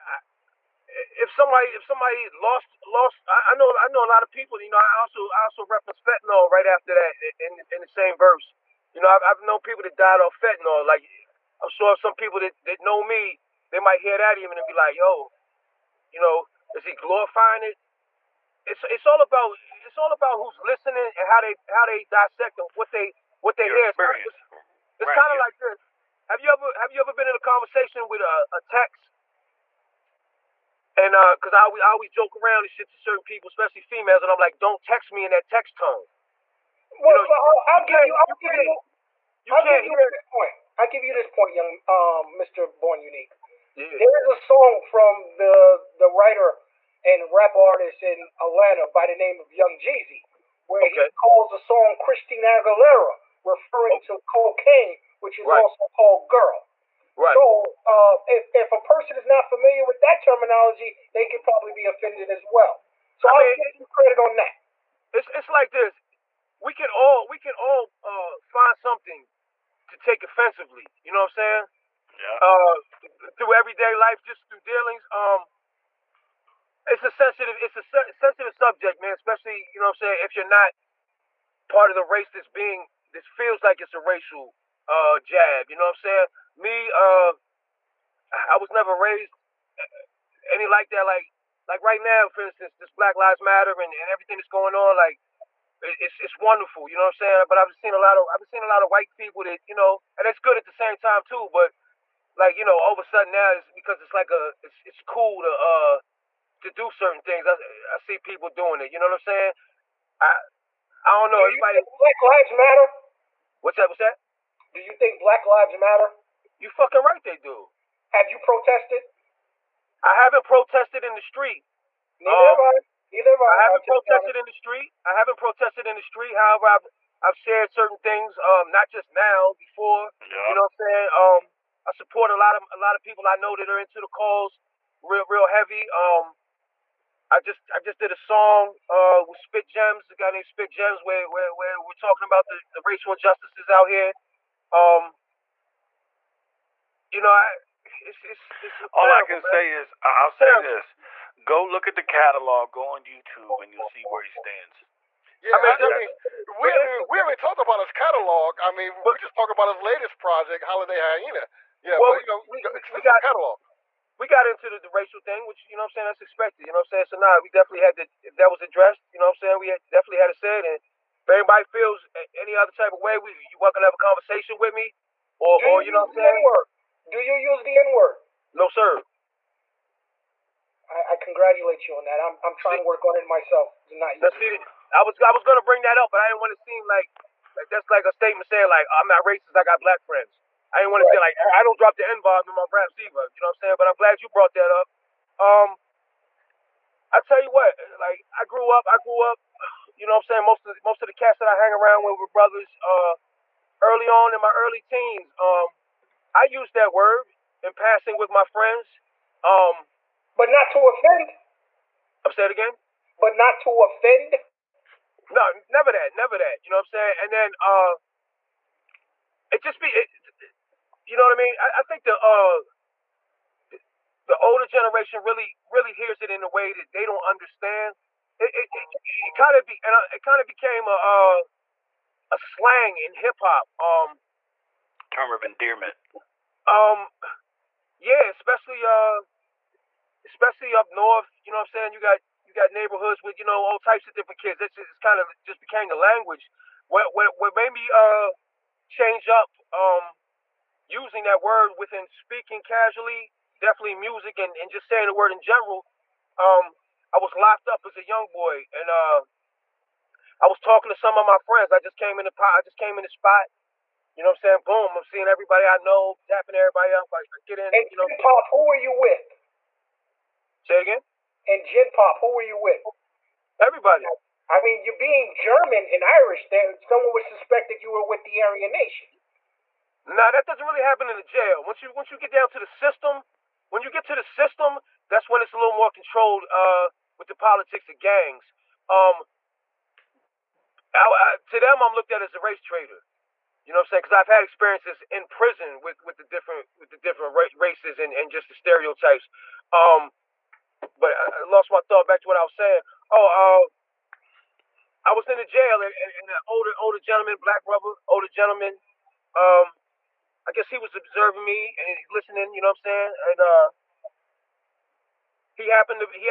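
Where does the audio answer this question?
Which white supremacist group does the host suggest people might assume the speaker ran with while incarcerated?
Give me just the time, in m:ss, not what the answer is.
4:38.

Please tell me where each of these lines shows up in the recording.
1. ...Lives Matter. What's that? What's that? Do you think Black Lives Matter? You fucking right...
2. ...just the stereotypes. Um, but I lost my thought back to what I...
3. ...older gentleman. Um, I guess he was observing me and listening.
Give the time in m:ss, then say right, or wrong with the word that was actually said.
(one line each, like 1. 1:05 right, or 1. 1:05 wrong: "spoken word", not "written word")
1. 1:52 right
2. 4:58 right
3. 5:08 right.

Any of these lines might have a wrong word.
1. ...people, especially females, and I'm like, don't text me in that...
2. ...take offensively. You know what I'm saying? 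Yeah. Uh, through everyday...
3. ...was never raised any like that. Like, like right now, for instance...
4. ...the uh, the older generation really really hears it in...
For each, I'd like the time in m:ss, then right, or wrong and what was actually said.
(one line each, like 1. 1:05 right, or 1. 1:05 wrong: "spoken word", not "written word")
1. 0:33 right
2. 1:09 right
3. 1:28 right
4. 3:42 right.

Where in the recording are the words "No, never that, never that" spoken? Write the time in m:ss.
3:35.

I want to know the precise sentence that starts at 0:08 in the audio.
You know, I've, I've known people that died off fentanyl.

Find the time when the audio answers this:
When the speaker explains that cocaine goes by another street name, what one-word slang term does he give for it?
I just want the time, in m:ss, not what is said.
0:56.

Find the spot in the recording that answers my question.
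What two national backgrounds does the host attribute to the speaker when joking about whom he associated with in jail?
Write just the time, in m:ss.
4:35.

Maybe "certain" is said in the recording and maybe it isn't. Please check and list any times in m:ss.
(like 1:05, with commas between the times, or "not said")
0:32, 1:46, 2:07.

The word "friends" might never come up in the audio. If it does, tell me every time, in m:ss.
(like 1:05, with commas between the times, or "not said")
3:10, 3:28, 4:21.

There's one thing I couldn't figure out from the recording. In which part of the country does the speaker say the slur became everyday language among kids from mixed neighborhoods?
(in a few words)
up north.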